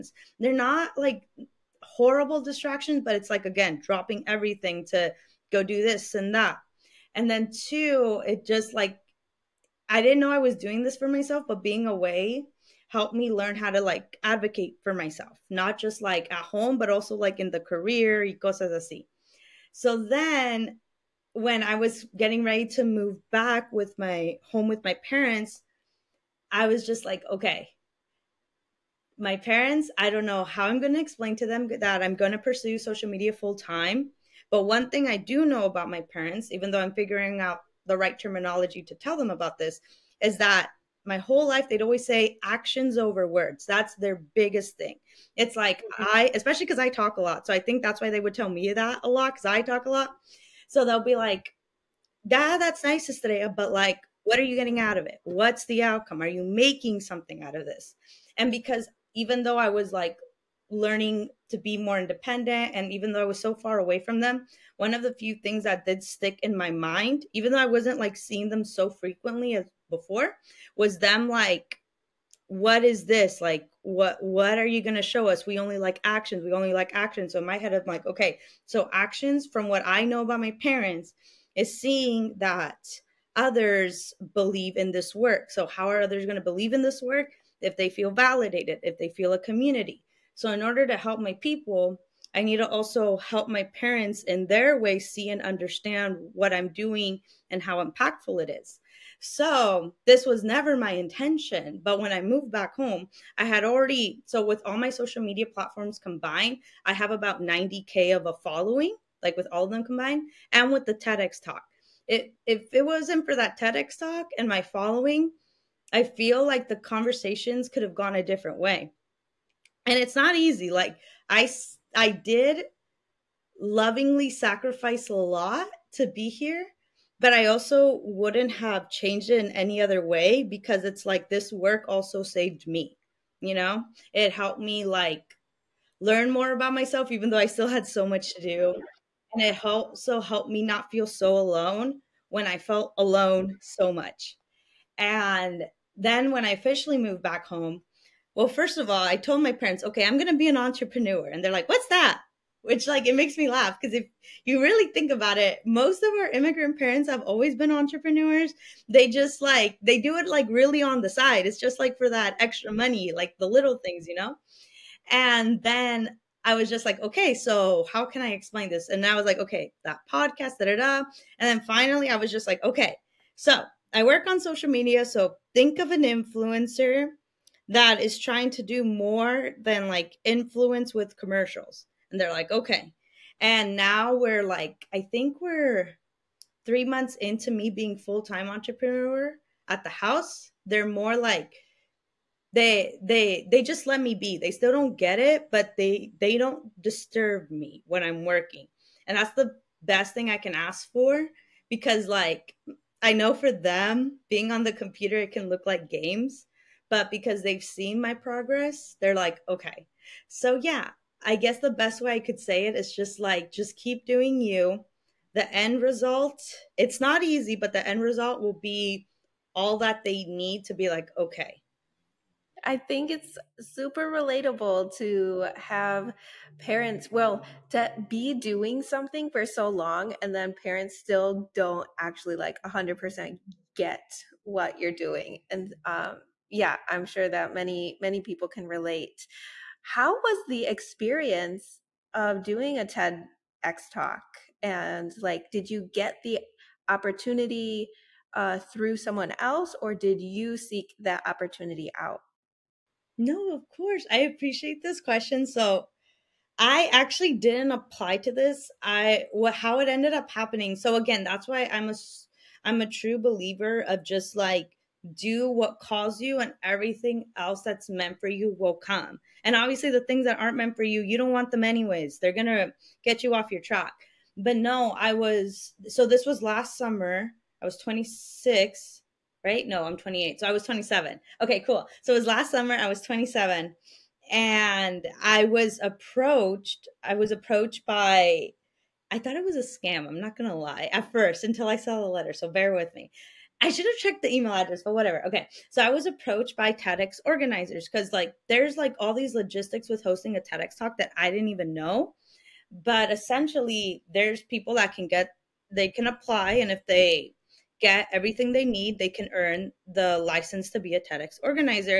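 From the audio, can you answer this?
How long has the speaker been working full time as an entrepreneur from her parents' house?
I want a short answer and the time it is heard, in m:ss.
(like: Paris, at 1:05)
three months, at 3:06.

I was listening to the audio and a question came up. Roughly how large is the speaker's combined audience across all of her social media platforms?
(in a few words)
90K.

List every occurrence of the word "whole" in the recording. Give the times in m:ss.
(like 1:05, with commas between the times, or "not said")
0:41.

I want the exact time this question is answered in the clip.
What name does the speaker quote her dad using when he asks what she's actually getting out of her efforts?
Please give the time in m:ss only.
0:53.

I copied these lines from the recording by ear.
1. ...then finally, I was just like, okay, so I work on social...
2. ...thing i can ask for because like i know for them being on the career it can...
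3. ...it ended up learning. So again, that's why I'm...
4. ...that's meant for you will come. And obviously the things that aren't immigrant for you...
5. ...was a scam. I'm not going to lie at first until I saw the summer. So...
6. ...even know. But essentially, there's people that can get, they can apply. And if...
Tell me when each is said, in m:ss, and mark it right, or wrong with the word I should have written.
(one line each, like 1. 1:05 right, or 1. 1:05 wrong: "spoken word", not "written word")
1. 2:51 right
2. 3:20 wrong: "computer", not "career"
3. 4:19 wrong: "happening", not "learning"
4. 4:27 wrong: "meant", not "immigrant"
5. 4:49 wrong: "letter", not "summer"
6. 5:01 right.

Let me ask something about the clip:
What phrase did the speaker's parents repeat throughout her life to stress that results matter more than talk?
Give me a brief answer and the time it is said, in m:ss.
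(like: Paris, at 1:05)
actions over words, at 0:42.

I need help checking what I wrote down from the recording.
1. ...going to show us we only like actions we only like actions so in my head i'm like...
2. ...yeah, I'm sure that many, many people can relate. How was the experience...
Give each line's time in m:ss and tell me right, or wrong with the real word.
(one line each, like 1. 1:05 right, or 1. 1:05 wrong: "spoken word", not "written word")
1. 1:14 right
2. 3:56 right.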